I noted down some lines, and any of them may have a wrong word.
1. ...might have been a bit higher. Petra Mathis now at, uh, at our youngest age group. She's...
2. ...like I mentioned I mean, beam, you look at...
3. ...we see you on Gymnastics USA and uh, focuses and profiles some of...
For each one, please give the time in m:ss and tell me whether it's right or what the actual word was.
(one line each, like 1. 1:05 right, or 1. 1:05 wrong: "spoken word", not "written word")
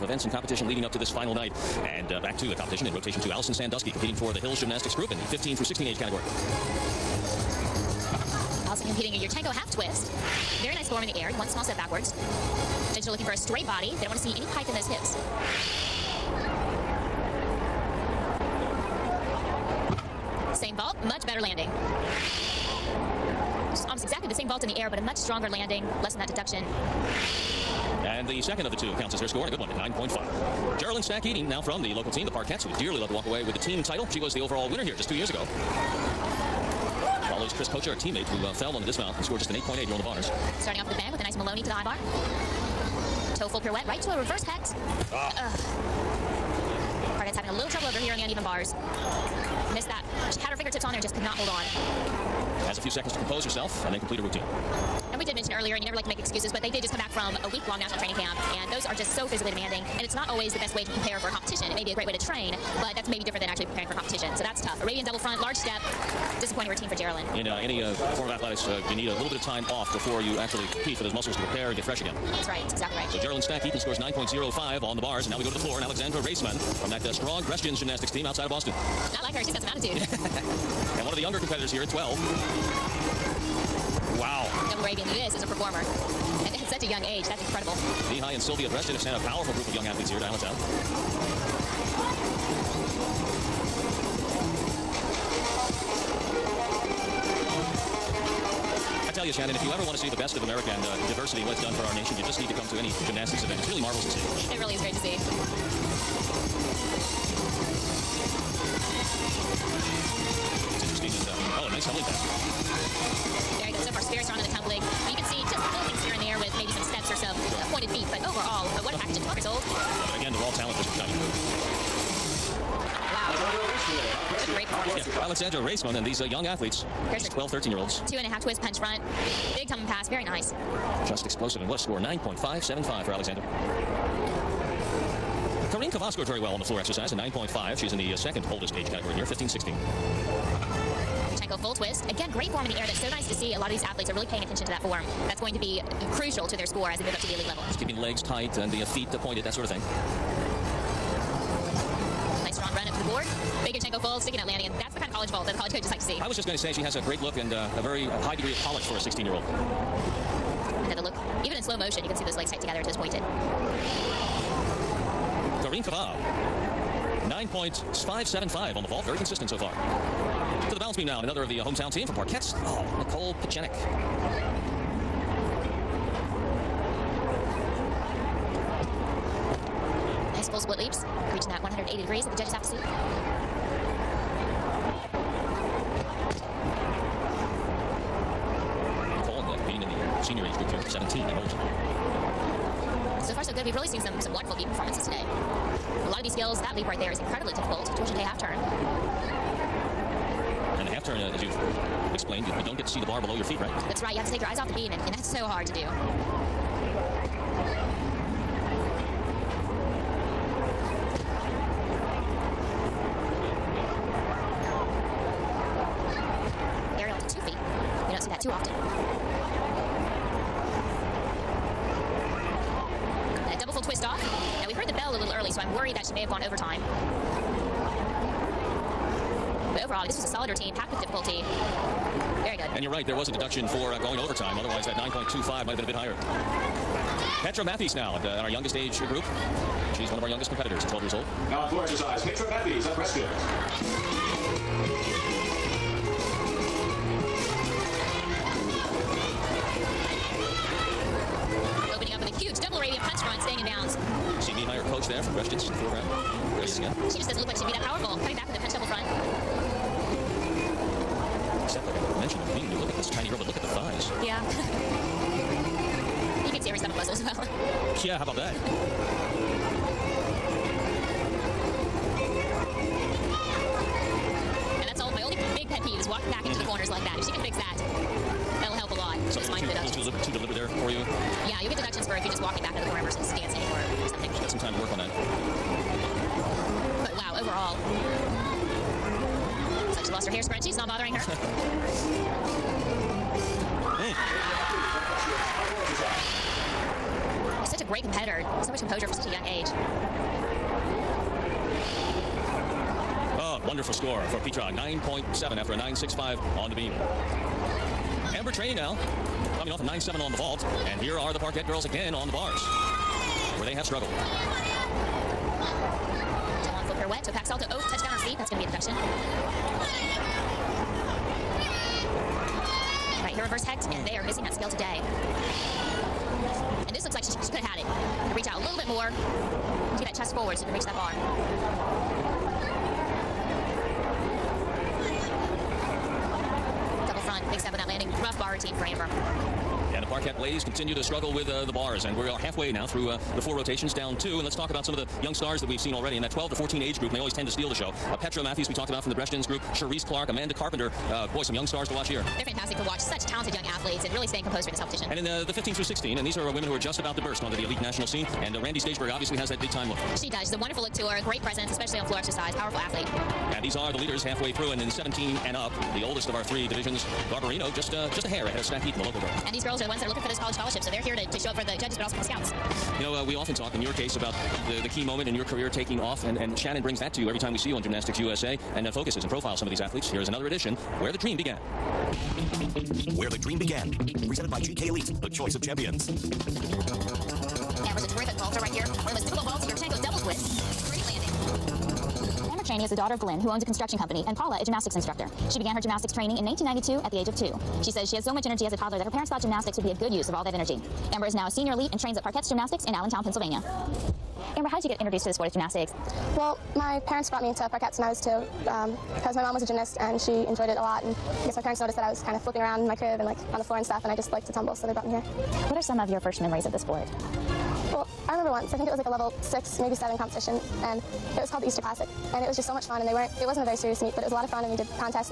1. 3:55 right
2. 4:21 right
3. 6:17 right.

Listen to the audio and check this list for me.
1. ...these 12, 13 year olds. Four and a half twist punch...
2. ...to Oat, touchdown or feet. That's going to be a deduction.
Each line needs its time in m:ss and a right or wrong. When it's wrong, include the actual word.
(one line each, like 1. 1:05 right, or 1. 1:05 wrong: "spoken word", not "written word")
1. 2:07 wrong: "Two", not "Four"
2. 5:17 right.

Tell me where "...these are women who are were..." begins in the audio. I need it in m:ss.
5:56.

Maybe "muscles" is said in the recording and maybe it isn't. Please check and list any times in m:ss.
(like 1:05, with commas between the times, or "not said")
1:11, 4:26.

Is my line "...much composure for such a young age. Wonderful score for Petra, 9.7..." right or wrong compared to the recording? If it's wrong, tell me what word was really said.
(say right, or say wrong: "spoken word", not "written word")
right.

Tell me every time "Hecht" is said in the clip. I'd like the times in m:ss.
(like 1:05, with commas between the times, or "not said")
0:44, 5:23.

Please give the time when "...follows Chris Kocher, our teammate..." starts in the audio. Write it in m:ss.
0:37.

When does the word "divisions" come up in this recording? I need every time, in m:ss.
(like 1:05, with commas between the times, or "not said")
6:06.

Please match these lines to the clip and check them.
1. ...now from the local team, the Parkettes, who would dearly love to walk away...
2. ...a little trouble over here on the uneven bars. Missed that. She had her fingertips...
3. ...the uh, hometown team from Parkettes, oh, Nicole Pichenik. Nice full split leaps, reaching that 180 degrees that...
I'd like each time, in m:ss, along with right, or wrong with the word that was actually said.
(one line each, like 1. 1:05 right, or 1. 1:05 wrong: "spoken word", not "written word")
1. 0:31 right
2. 0:47 right
3. 2:51 right.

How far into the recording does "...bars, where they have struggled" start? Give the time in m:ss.
5:12.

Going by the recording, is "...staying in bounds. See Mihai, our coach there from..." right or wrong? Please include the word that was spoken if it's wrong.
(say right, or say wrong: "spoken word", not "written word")
right.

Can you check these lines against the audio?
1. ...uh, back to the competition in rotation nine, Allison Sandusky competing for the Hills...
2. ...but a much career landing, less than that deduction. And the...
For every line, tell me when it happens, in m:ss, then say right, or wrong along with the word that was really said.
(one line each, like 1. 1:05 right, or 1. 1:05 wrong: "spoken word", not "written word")
1. 0:02 wrong: "two", not "nine"
2. 0:24 wrong: "stronger", not "career".